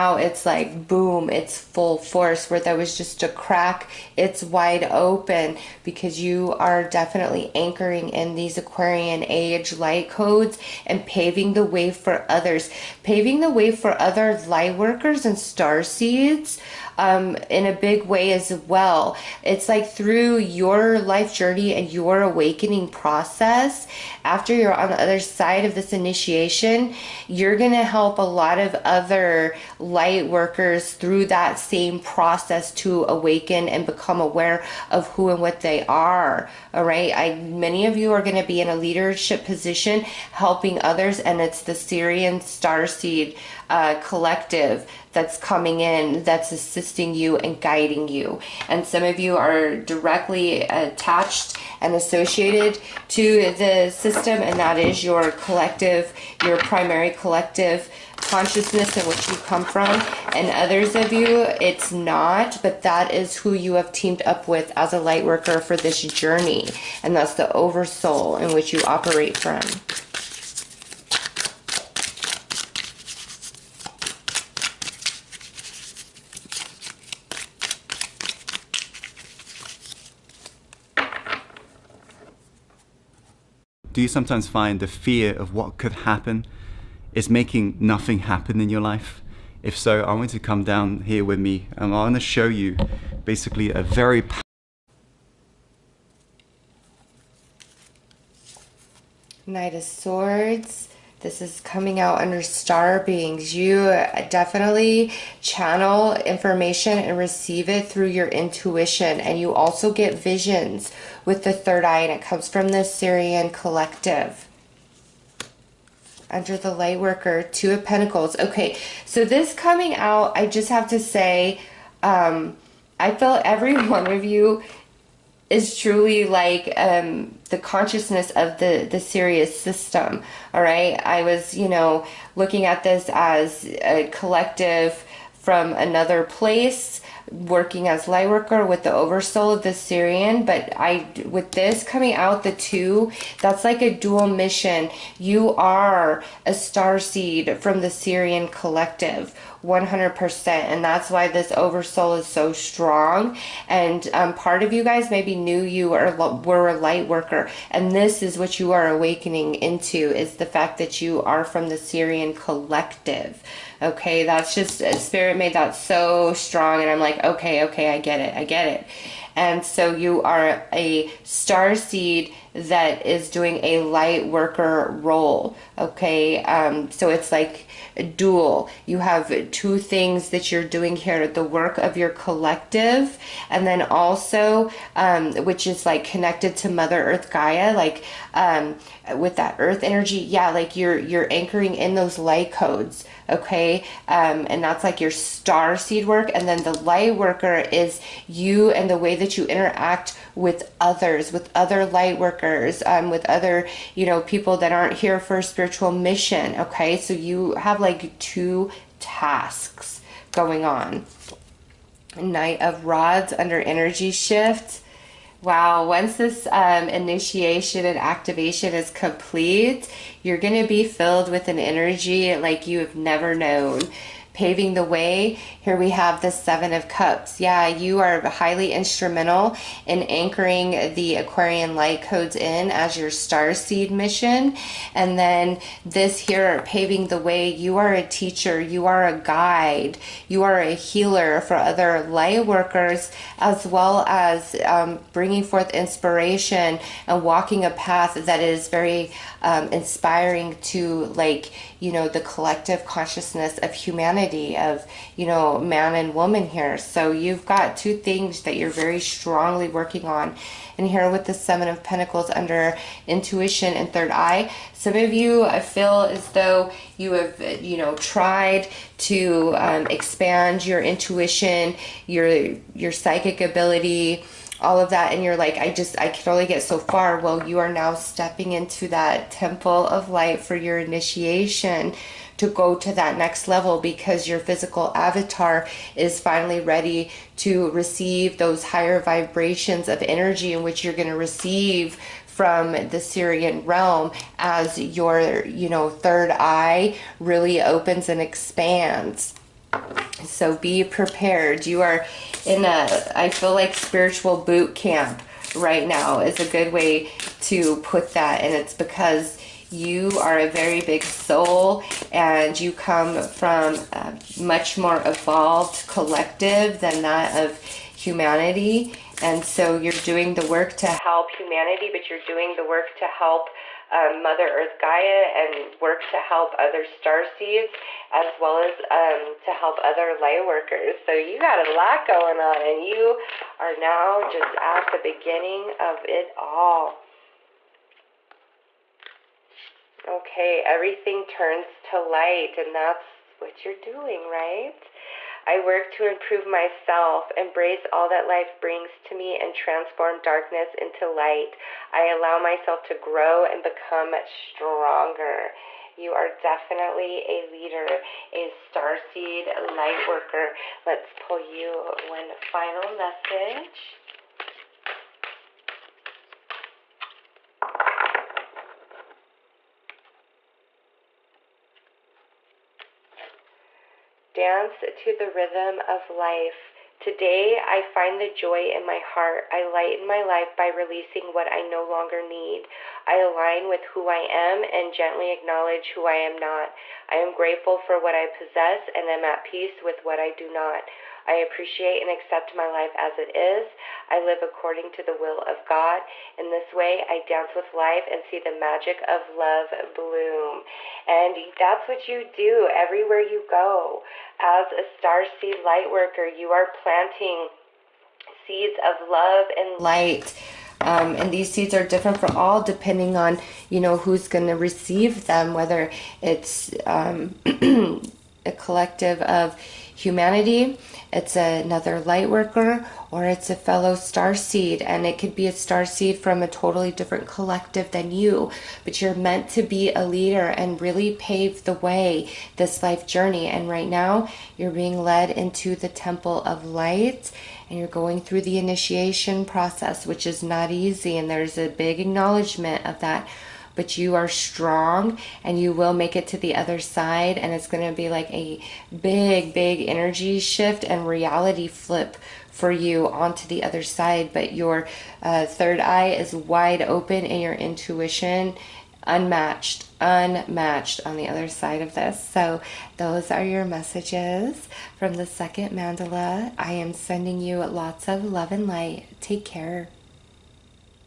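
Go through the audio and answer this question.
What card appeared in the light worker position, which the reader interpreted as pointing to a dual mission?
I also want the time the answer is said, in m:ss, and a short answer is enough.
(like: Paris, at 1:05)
Two of Pentacles, at 1:57.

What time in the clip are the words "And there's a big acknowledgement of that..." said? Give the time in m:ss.
7:21.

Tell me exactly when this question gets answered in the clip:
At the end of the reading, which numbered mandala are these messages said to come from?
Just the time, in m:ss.
7:45.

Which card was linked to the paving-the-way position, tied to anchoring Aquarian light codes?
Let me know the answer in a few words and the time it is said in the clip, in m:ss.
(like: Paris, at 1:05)
Seven of Cups, at 3:46.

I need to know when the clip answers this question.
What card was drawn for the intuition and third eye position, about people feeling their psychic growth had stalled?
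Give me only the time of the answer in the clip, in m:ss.
4:21.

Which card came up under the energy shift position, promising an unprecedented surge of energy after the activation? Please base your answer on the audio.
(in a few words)
Knight of Rods.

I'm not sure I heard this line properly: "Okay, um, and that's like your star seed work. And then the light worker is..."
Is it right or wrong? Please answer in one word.
right.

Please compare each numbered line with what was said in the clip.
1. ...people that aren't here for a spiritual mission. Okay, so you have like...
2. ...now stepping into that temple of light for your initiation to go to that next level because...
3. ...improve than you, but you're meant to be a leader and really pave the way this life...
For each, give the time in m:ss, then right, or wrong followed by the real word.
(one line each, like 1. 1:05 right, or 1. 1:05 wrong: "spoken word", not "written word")
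1. 3:24 right
2. 4:37 right
3. 7:07 wrong: "collective", not "improve".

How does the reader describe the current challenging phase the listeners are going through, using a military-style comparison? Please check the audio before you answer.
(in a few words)
spiritual boot camp.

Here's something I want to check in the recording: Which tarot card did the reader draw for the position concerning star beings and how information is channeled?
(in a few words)
Knight of Swords.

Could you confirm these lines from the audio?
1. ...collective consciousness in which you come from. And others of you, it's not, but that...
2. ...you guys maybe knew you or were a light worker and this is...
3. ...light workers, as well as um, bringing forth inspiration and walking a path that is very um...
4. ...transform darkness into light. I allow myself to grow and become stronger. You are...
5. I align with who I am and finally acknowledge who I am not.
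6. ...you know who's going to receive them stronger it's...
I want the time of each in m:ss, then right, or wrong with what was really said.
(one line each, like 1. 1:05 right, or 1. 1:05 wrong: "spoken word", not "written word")
1. 0:57 right
2. 2:34 right
3. 4:02 right
4. 5:49 right
5. 6:23 wrong: "gently", not "finally"
6. 6:53 wrong: "whether", not "stronger".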